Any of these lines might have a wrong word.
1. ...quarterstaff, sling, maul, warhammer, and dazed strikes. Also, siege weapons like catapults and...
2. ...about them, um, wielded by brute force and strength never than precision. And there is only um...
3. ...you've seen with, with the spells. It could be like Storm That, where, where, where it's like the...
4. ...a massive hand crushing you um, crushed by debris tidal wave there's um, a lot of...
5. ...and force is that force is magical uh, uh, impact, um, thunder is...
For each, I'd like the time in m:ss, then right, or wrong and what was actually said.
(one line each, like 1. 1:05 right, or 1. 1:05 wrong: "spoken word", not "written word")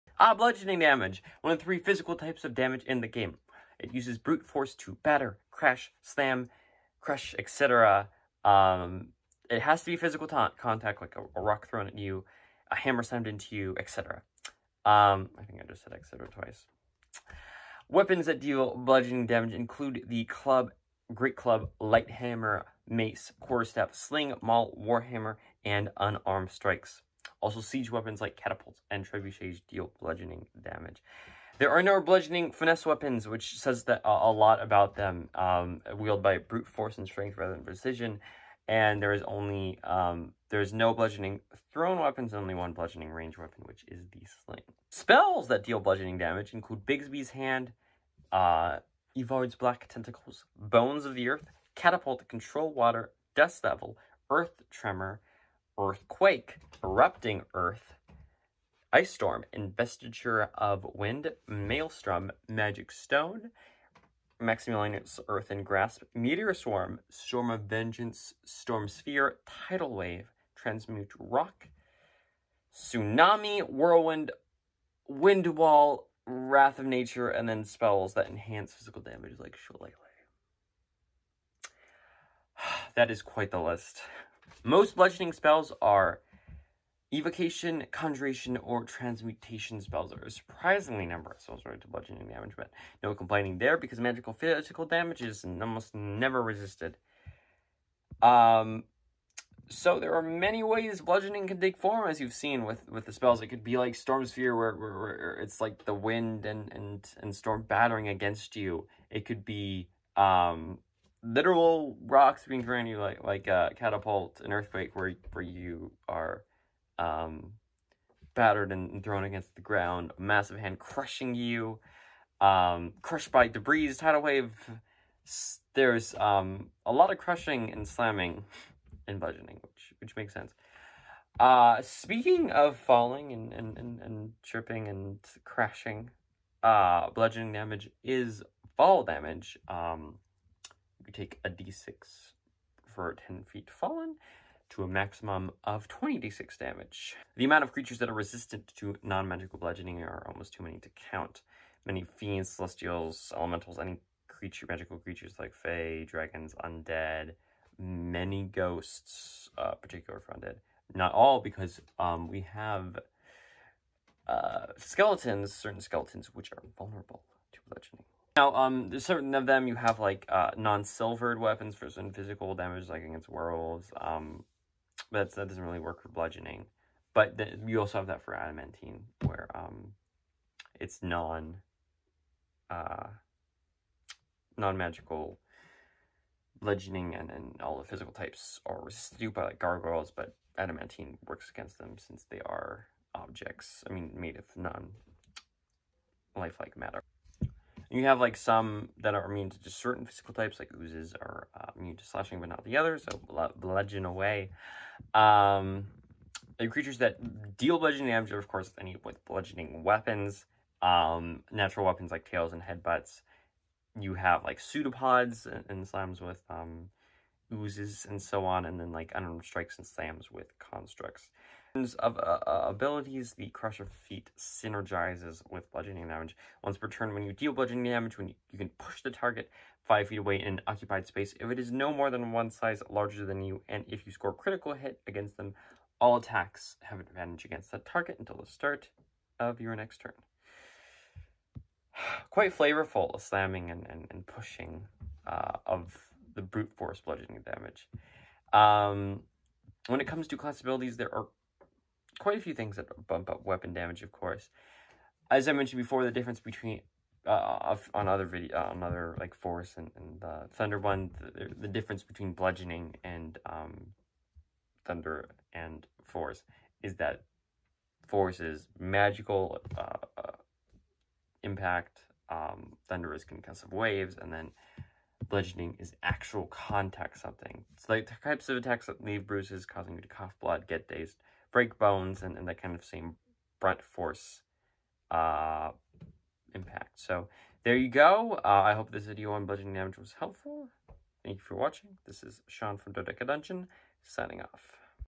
1. 0:23 wrong: "unarmed", not "dazed"
2. 0:34 wrong: "rather", not "never"
3. 1:42 wrong: "Sphere", not "That"
4. 2:00 right
5. 4:25 right.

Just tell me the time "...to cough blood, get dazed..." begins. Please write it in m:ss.
4:40.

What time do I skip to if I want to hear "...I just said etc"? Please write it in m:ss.
0:15.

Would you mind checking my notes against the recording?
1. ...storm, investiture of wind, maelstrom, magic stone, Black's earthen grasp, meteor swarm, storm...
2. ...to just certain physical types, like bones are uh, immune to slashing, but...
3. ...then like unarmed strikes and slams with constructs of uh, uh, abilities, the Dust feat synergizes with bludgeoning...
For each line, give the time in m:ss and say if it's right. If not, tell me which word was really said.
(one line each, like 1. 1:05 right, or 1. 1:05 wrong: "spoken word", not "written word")
1. 0:59 wrong: "Maximilian", not "Black"
2. 3:19 wrong: "oozes", not "bones"
3. 3:38 wrong: "Crusher", not "Dust".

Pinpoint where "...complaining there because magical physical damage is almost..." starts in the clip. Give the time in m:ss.
1:33.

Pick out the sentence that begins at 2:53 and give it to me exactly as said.
Um, but that doesn't really work for bludgeoning.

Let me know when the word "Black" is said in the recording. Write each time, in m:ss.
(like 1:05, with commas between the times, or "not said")
0:49.